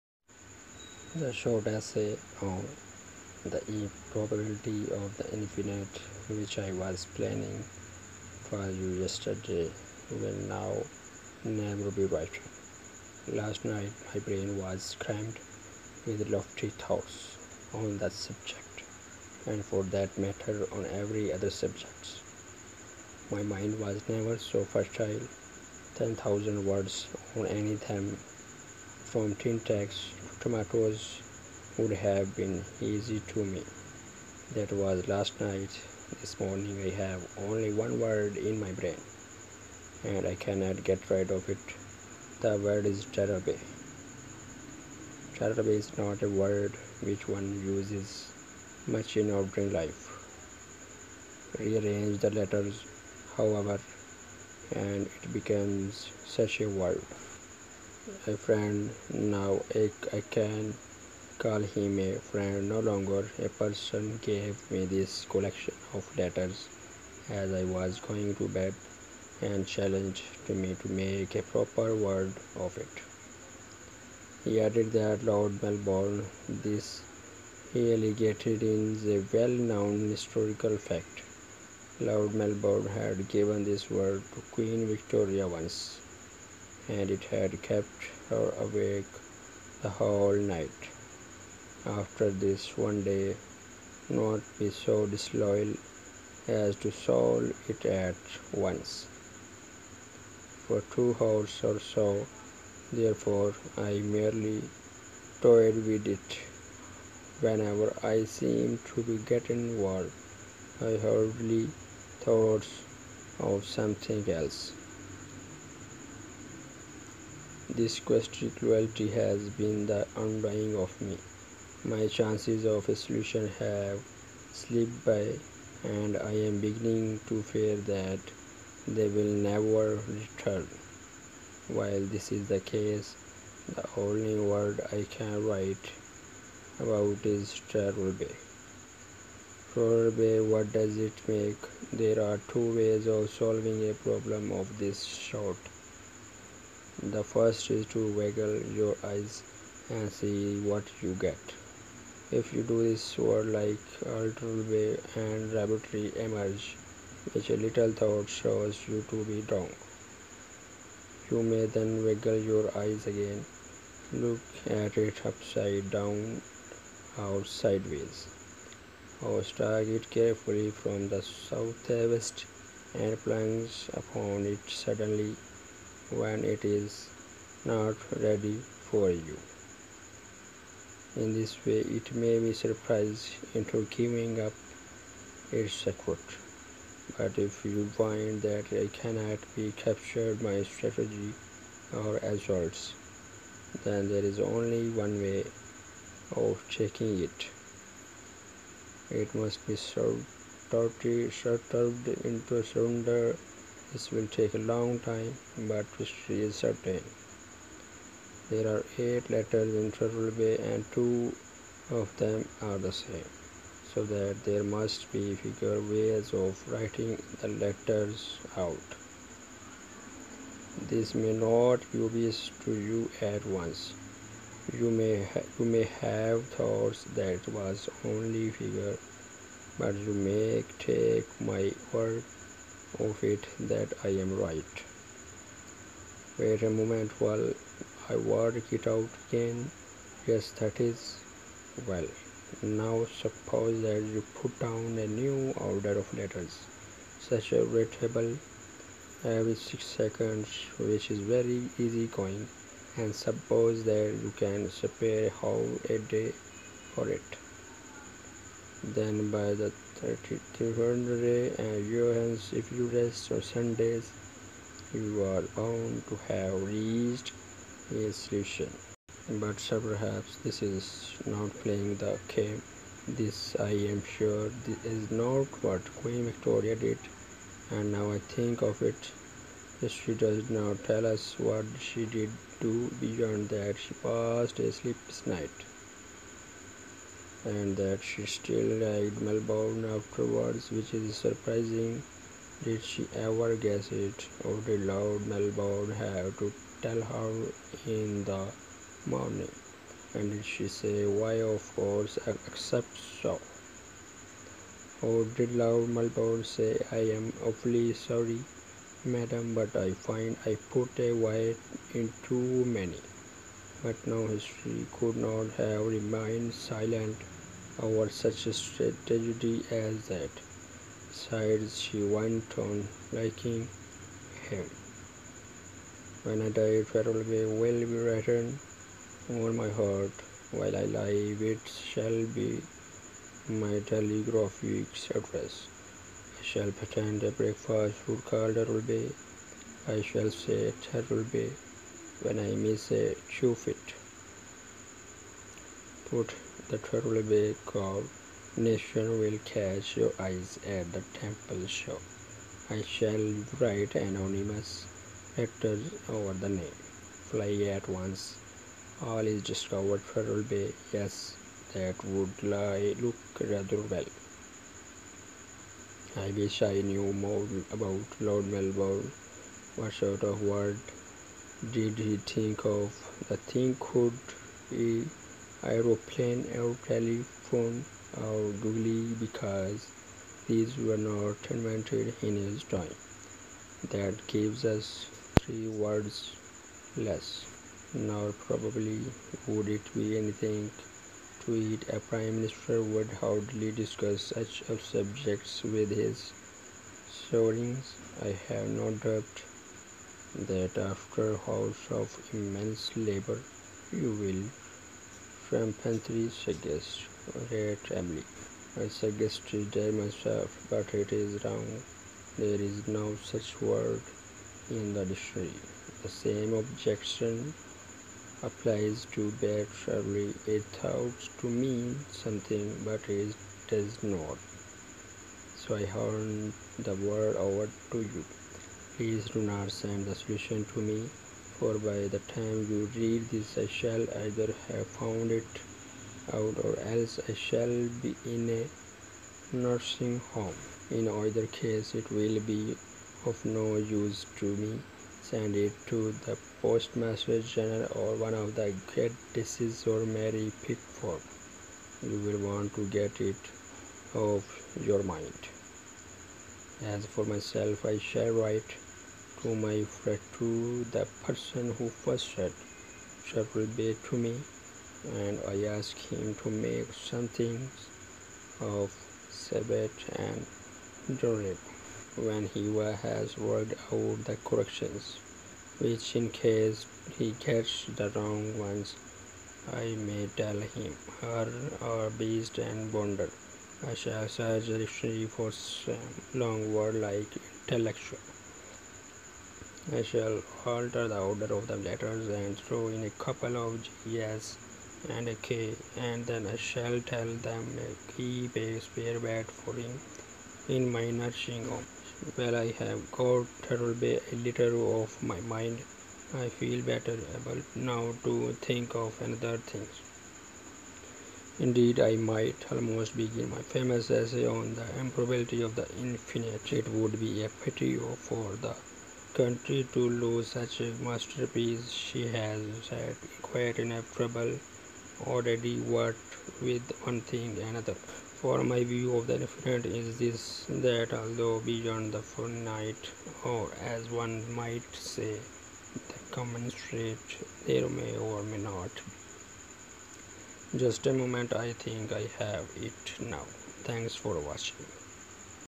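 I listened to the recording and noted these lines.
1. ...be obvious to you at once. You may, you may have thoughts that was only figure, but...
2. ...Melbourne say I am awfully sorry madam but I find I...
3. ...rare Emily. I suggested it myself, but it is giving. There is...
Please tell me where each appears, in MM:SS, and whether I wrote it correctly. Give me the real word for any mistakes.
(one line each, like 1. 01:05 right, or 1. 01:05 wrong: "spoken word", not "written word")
1. 03:41 right
2. 05:05 right
3. 06:47 wrong: "wrong", not "giving".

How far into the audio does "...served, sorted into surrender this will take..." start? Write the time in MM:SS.
03:19.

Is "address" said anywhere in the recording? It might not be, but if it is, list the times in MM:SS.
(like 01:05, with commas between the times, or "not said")
05:35.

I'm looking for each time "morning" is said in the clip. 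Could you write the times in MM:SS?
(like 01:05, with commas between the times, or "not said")
00:36, 04:59.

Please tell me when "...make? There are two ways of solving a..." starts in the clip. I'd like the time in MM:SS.
02:21.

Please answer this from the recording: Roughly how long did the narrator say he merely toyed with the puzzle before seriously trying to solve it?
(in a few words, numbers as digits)
Two hours.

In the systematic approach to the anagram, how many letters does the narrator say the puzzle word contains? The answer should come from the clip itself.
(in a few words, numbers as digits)
8.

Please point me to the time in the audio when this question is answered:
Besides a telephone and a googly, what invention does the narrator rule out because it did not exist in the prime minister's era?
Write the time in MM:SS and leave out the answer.
06:15.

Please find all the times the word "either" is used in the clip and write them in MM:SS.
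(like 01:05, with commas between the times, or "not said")
07:14, 07:21.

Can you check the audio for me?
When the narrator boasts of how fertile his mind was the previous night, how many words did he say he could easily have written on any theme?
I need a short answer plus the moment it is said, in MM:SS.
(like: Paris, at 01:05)
10,000, at 00:25.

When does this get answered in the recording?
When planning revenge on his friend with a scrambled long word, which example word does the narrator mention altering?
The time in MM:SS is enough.
08:07.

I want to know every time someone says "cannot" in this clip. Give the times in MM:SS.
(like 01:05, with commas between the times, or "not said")
00:40, 03:08.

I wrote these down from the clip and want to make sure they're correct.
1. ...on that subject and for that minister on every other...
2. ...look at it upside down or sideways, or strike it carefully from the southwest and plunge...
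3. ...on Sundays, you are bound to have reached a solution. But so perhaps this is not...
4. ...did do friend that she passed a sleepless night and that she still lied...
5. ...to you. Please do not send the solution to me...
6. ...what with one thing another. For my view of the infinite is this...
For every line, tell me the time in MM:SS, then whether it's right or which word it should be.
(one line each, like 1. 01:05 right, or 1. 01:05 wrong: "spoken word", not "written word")
1. 00:17 wrong: "matter", not "minister"
2. 02:44 right
3. 04:23 right
4. 04:42 wrong: "beyond", not "friend"
5. 07:07 right
6. 08:45 right.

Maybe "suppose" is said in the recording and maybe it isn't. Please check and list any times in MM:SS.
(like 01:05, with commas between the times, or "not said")
04:03, 04:13.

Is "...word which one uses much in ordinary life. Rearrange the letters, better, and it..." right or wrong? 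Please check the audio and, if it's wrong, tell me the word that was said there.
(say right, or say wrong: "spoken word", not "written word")
wrong: "however", not "better".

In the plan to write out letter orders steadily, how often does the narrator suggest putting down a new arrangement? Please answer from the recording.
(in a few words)
Every 6 seconds.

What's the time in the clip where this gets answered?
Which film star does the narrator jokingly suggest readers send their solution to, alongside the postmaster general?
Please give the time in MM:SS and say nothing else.
07:30.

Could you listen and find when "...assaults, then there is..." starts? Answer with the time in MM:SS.
03:12.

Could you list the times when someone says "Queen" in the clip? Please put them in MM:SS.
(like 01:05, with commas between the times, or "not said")
01:24, 04:36.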